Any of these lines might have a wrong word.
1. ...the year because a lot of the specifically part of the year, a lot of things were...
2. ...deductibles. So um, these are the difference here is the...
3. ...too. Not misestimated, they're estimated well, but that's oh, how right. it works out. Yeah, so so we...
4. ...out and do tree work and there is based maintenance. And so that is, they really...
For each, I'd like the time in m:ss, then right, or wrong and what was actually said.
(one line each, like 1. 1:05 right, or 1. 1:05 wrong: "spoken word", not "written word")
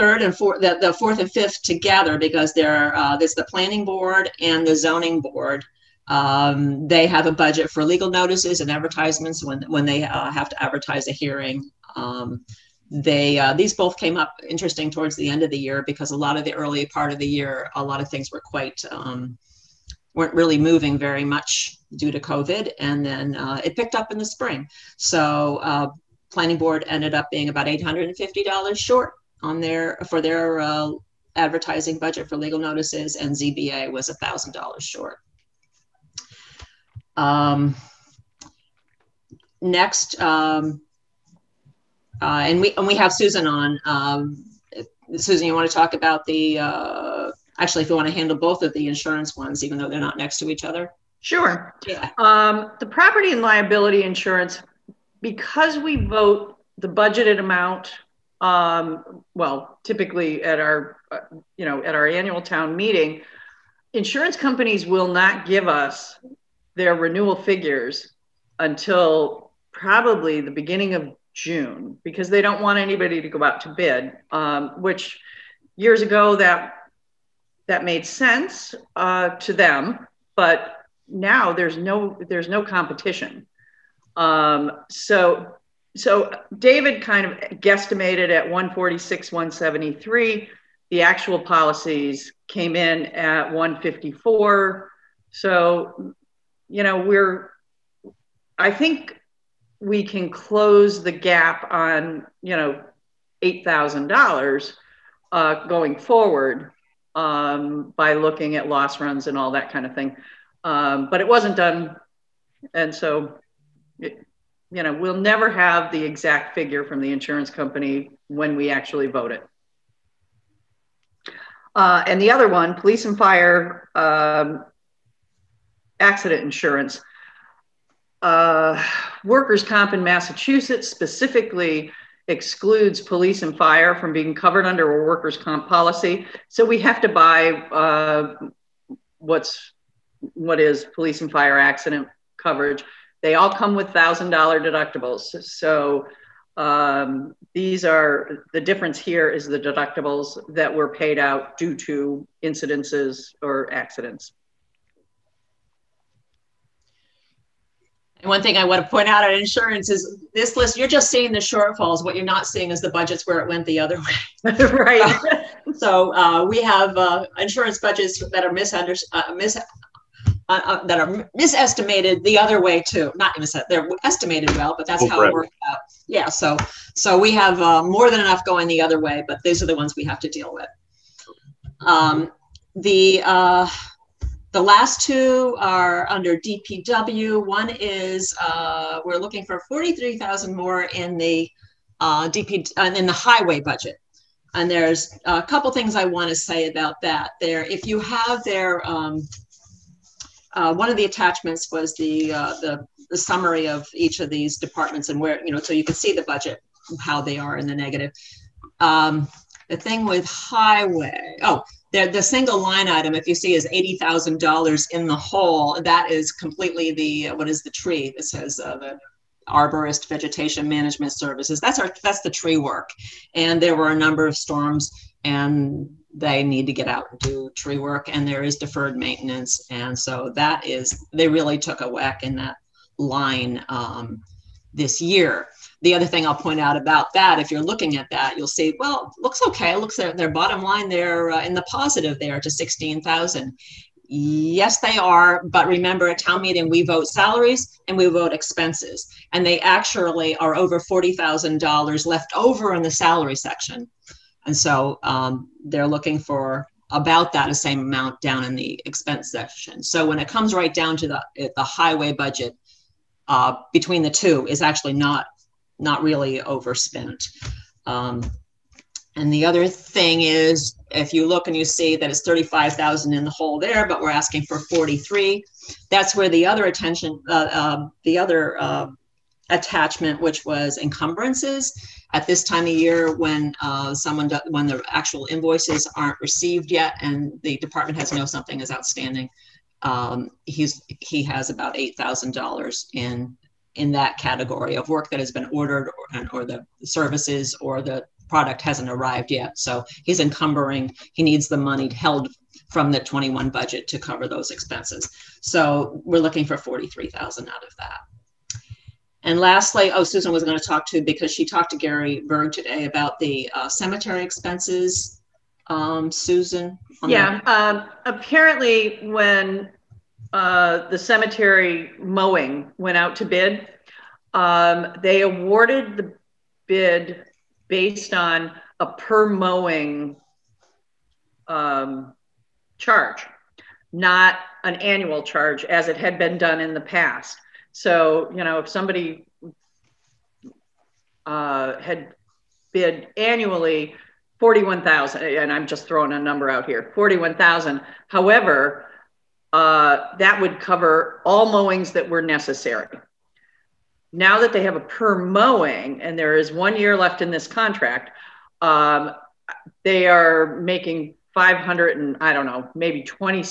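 1. 0:15 wrong: "early", not "specifically"
2. 2:24 right
3. 2:52 right
4. 3:46 wrong: "deferred", not "based".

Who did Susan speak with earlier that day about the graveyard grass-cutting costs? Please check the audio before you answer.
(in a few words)
Gary Berg.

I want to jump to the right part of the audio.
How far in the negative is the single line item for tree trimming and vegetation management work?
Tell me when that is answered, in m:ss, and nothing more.
3:33.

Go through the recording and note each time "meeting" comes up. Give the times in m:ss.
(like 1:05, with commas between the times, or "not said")
1:02, 4:06.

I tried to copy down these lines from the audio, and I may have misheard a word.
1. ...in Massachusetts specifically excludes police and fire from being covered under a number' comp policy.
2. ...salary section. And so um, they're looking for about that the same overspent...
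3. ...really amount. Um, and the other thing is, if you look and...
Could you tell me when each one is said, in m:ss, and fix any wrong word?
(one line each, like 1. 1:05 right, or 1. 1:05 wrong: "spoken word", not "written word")
1. 2:09 wrong: "workers", not "number"
2. 4:12 wrong: "amount", not "overspent"
3. 4:26 wrong: "overspent", not "amount".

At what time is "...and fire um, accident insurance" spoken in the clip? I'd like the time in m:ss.
2:03.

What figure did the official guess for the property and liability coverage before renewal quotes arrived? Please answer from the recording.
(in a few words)
146,173.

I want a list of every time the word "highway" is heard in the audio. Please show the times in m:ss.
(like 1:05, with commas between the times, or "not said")
3:13, 3:30, 4:21.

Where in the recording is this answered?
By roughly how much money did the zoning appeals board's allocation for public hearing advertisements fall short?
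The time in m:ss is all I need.
0:34.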